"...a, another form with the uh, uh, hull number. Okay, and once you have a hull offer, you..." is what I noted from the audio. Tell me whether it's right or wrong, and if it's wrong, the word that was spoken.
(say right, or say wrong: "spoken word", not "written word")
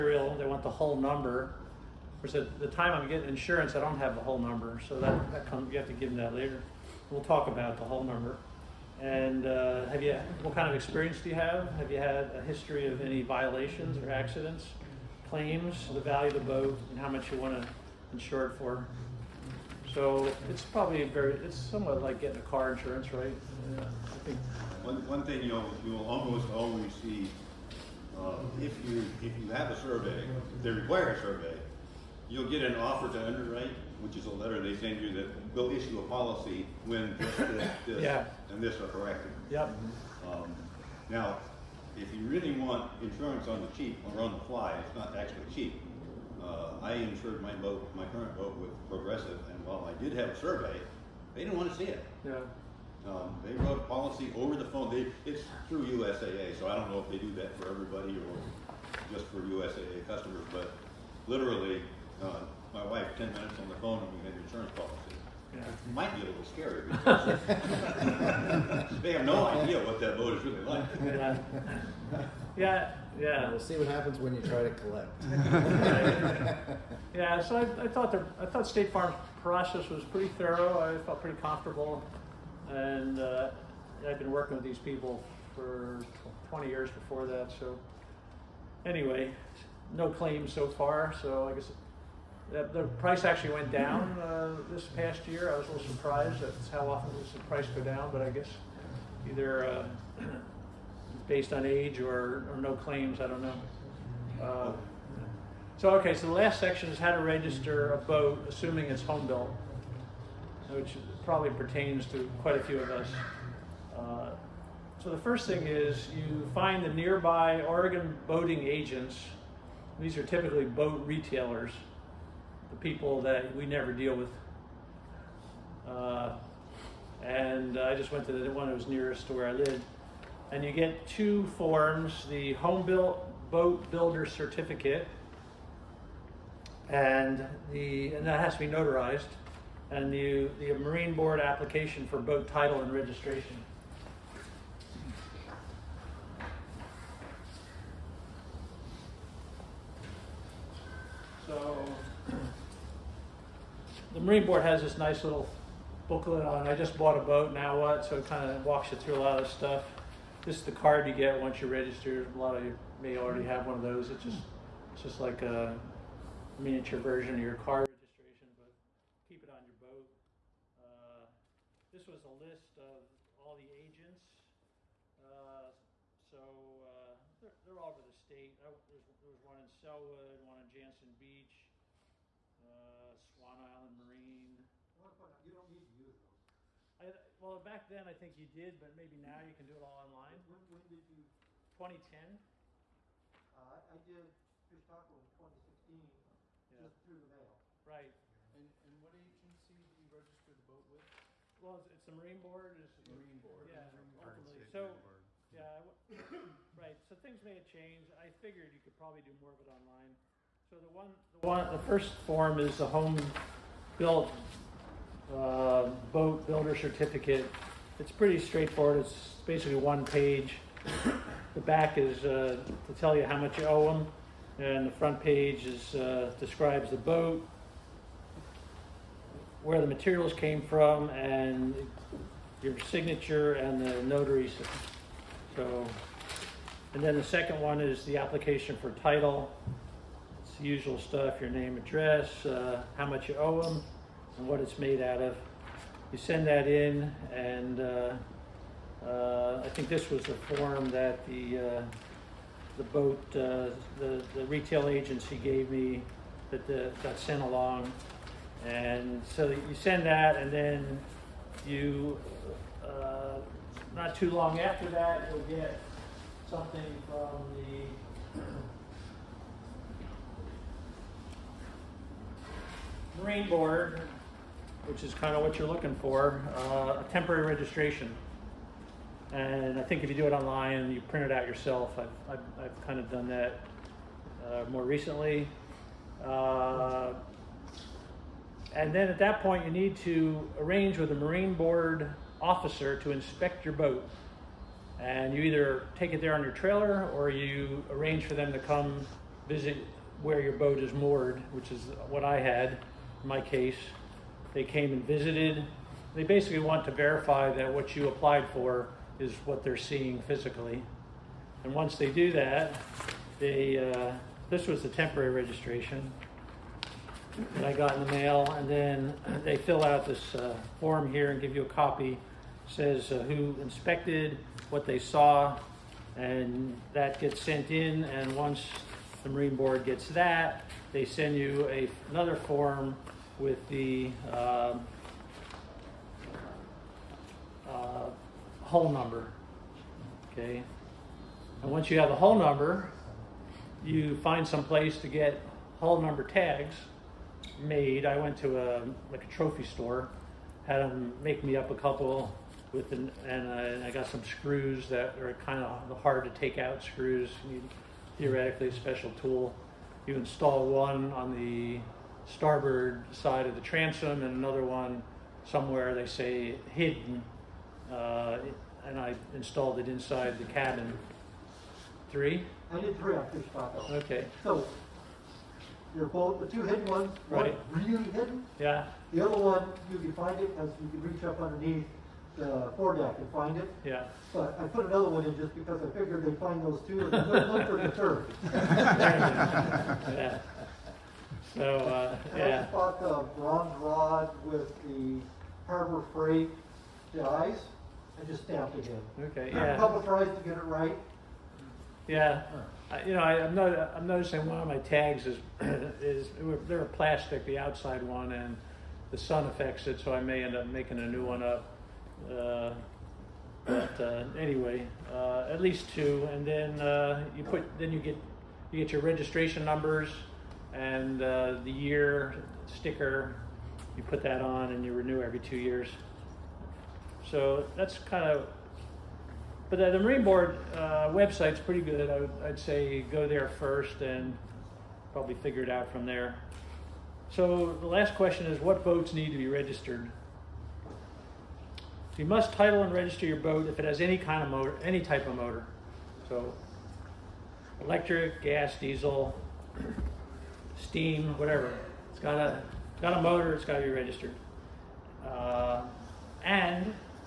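wrong: "number", not "offer".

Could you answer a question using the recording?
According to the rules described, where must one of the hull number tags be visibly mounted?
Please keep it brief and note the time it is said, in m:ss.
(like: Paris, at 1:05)
starboard side of the transom, at 6:02.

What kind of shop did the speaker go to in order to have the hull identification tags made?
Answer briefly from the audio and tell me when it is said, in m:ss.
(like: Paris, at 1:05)
a trophy store, at 5:49.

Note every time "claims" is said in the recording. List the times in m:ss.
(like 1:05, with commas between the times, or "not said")
0:15, 1:30, 1:42.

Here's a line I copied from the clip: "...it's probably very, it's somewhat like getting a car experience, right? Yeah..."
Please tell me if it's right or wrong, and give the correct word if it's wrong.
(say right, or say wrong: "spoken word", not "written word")
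wrong: "insurance", not "experience".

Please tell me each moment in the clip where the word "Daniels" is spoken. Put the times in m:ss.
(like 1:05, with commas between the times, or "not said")
not said.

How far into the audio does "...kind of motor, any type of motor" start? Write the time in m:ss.
7:24.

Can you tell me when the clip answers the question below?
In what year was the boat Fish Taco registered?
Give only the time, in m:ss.
3:15.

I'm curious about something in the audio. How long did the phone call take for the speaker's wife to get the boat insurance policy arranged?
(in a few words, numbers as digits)
10 minutes.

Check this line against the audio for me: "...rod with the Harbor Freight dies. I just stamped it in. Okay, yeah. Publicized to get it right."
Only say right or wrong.
right.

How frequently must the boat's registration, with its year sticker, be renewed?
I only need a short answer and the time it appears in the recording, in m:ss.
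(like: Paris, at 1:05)
every 2 years, at 7:05.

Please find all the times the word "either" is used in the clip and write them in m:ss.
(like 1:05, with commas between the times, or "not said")
1:39, 4:55.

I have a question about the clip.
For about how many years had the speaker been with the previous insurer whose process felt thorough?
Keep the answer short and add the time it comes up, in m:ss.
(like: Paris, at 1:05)
20 years, at 1:26.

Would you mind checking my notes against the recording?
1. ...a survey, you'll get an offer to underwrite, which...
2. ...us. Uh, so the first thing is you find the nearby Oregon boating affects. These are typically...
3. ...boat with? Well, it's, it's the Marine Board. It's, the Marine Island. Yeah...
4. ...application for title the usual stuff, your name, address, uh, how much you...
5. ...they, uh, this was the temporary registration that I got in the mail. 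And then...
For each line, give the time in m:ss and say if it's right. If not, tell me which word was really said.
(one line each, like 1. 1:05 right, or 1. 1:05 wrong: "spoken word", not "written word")
1. 0:31 right
2. 1:52 wrong: "agents", not "affects"
3. 3:20 wrong: "Board", not "Island"
4. 3:58 right
5. 5:13 right.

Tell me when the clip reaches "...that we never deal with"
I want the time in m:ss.
2:03.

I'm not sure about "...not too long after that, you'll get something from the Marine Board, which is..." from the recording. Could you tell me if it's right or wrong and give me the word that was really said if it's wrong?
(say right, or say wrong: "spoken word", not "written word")
right.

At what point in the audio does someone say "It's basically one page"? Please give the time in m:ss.
3:38.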